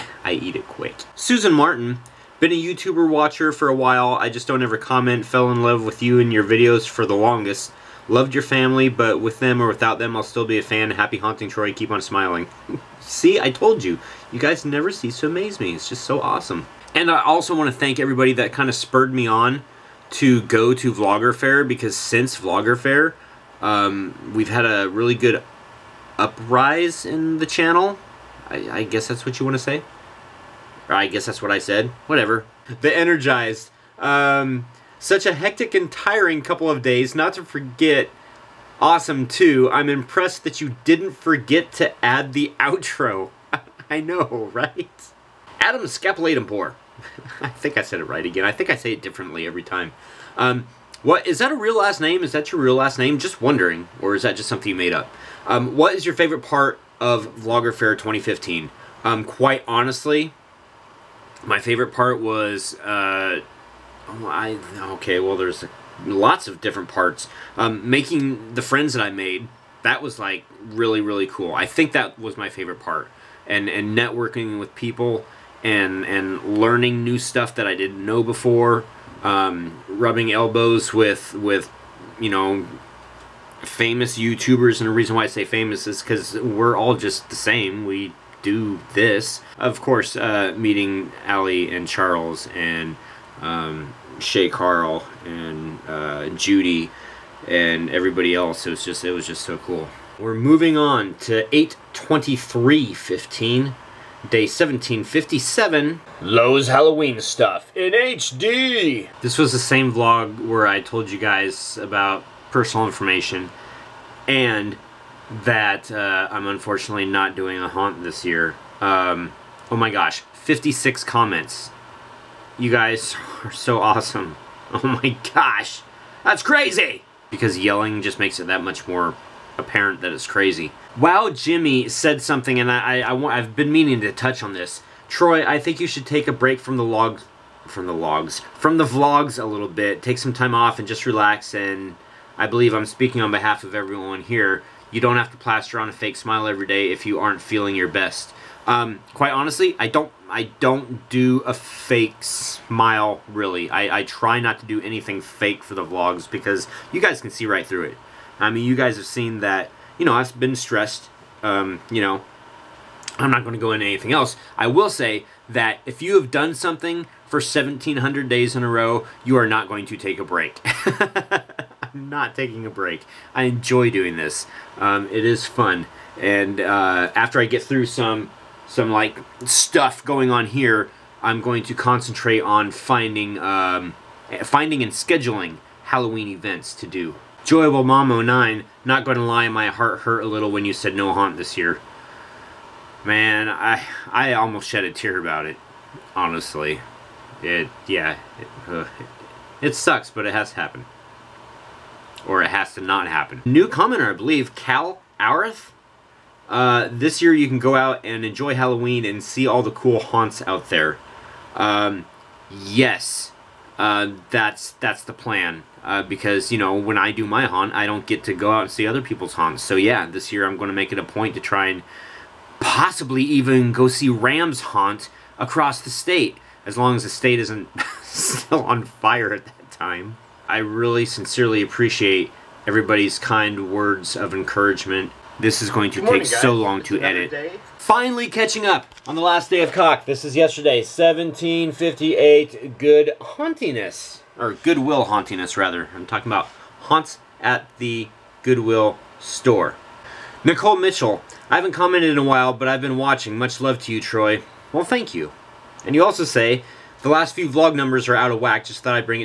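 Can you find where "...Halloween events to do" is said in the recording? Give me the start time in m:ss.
3:05.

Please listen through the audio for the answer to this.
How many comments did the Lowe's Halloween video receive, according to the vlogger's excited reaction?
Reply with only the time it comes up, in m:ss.
2:00.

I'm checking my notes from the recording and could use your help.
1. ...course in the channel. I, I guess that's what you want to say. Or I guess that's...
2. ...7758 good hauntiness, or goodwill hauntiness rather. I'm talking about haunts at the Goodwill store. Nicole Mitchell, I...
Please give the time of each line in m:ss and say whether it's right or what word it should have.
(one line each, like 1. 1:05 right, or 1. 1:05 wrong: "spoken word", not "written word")
1. 0:26 wrong: "uprise", not "course"
2. 4:00 wrong: "1758", not "7758".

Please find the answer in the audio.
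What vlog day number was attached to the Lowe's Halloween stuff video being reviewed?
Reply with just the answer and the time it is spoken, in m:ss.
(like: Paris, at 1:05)
1757, at 1:44.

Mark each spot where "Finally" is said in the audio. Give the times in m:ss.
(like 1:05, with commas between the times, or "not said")
3:57.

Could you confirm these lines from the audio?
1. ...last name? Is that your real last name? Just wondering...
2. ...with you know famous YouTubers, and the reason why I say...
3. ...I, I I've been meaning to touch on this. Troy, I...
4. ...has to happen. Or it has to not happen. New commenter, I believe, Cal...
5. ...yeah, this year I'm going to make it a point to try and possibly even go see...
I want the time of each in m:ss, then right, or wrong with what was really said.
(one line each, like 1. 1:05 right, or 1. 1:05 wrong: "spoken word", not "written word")
1. 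0:51 right
2. 1:21 right
3. 2:12 right
4. 3:20 right
5. 3:39 right.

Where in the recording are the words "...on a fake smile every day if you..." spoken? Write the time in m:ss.
2:25.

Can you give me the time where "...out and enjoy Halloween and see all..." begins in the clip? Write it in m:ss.
3:27.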